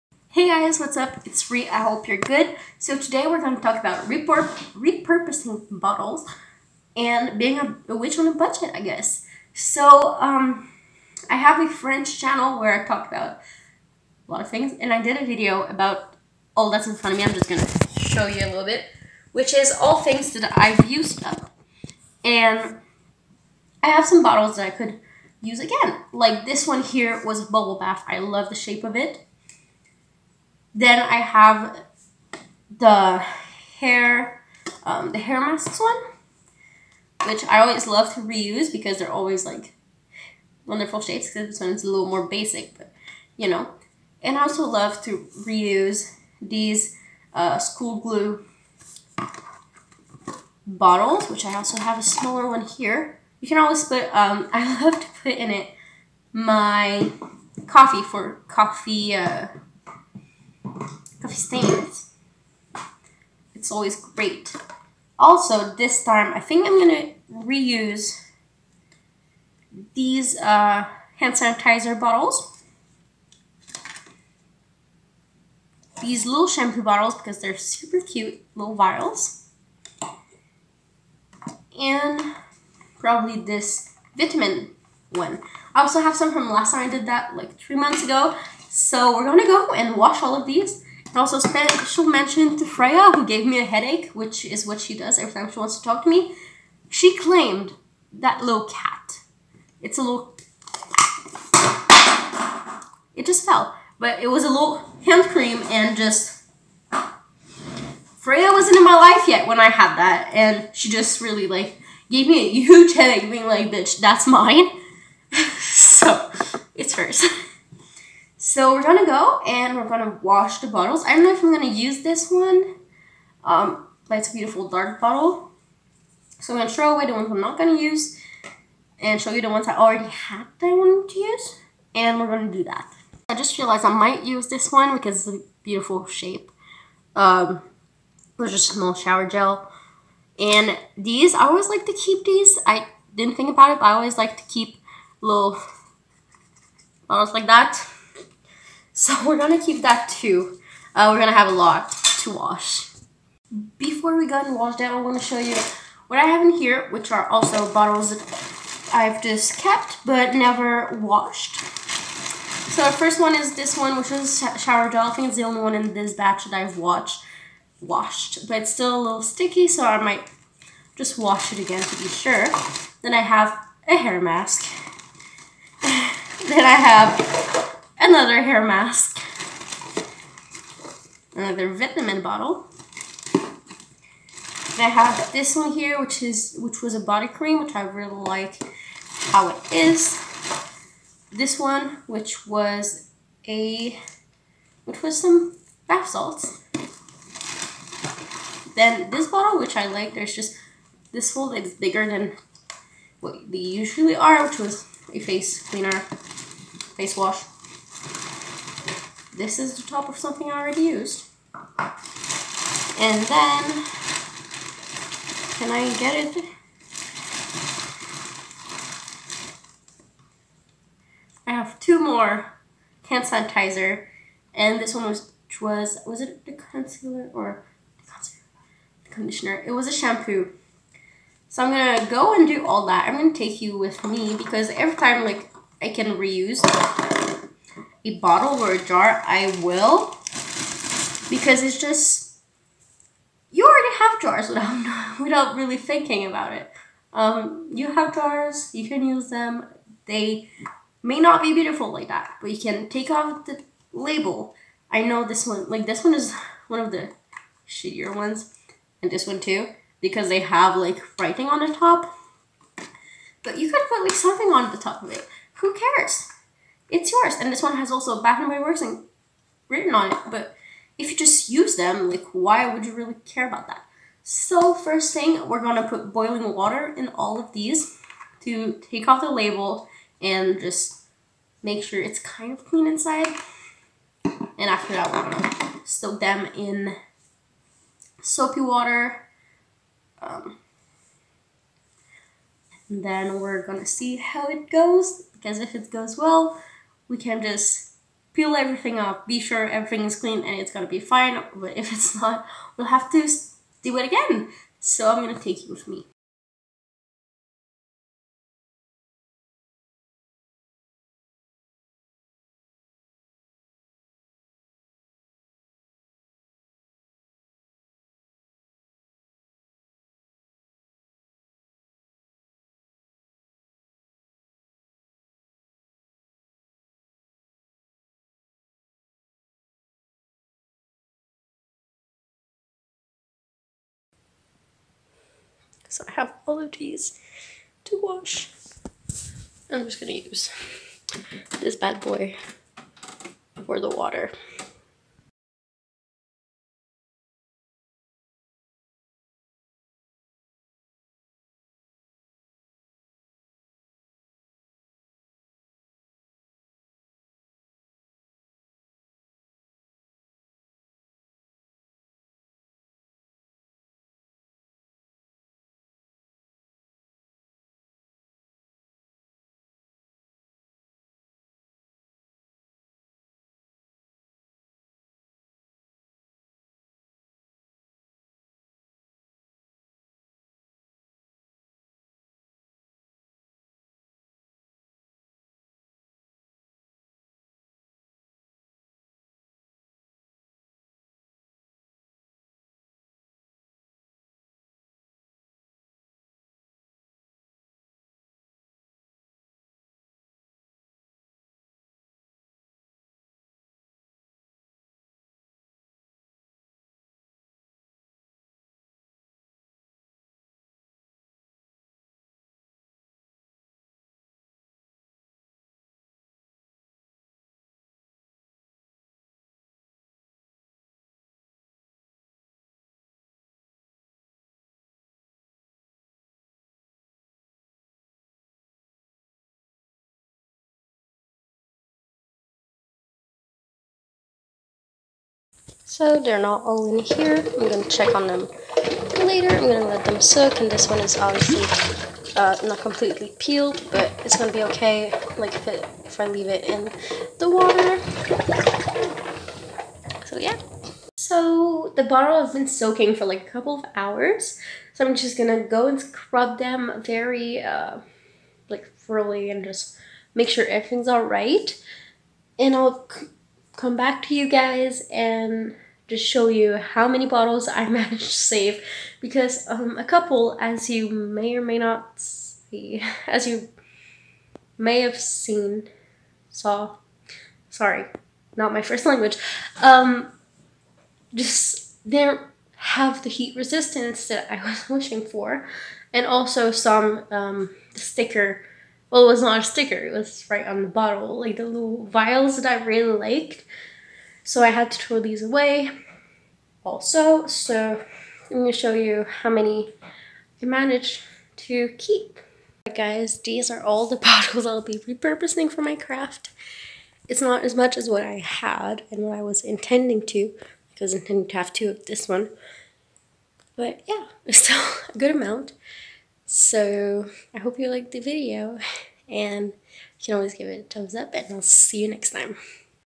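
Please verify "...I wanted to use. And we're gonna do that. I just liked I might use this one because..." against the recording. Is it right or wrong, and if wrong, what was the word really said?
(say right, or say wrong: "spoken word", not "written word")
wrong: "realized", not "liked".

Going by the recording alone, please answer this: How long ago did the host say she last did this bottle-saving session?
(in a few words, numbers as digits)
3 months ago.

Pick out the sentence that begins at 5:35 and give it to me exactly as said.
because I have all of these to wash.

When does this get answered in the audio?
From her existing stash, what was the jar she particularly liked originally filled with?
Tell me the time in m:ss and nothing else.
3:06.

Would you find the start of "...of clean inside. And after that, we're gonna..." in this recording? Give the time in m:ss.
4:42.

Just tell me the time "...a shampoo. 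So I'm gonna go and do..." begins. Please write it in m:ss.
3:49.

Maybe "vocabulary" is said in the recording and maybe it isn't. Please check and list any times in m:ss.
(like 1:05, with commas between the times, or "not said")
not said.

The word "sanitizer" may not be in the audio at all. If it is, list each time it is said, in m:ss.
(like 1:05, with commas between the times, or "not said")
1:11, 3:43.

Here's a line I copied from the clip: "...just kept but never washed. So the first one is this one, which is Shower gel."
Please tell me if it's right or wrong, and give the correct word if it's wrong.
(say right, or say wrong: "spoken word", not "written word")
right.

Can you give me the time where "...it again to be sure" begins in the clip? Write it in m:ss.
2:51.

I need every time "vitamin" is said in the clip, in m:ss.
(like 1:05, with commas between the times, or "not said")
1:24, 3:01.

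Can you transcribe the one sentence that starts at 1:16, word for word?
These little shampoo bottles because they're super cute little vials.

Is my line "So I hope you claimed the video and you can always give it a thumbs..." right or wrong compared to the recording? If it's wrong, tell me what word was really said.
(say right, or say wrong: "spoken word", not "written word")
wrong: "liked", not "claimed".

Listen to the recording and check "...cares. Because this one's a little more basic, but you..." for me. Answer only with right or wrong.
wrong.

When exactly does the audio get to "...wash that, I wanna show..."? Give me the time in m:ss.
2:34.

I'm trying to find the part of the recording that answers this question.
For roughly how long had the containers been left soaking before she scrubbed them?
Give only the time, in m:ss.
7:33.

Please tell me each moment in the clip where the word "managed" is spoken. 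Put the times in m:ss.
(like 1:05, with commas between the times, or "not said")
7:47, 8:20.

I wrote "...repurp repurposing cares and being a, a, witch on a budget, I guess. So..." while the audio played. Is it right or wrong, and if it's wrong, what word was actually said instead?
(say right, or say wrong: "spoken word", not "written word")
wrong: "bottles", not "cares".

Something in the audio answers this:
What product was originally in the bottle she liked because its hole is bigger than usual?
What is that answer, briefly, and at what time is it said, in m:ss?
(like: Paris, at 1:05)
Face wash, at 3:26.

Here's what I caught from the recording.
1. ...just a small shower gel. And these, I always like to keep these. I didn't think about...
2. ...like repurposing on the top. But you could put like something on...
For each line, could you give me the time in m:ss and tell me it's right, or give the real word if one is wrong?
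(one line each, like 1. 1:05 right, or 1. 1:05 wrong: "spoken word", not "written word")
1. 2:18 right
2. 4:20 wrong: "writing", not "repurposing".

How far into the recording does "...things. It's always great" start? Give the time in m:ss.
1:01.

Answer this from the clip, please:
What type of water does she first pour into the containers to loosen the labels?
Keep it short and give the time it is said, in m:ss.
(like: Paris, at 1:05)
Boiling water, at 4:36.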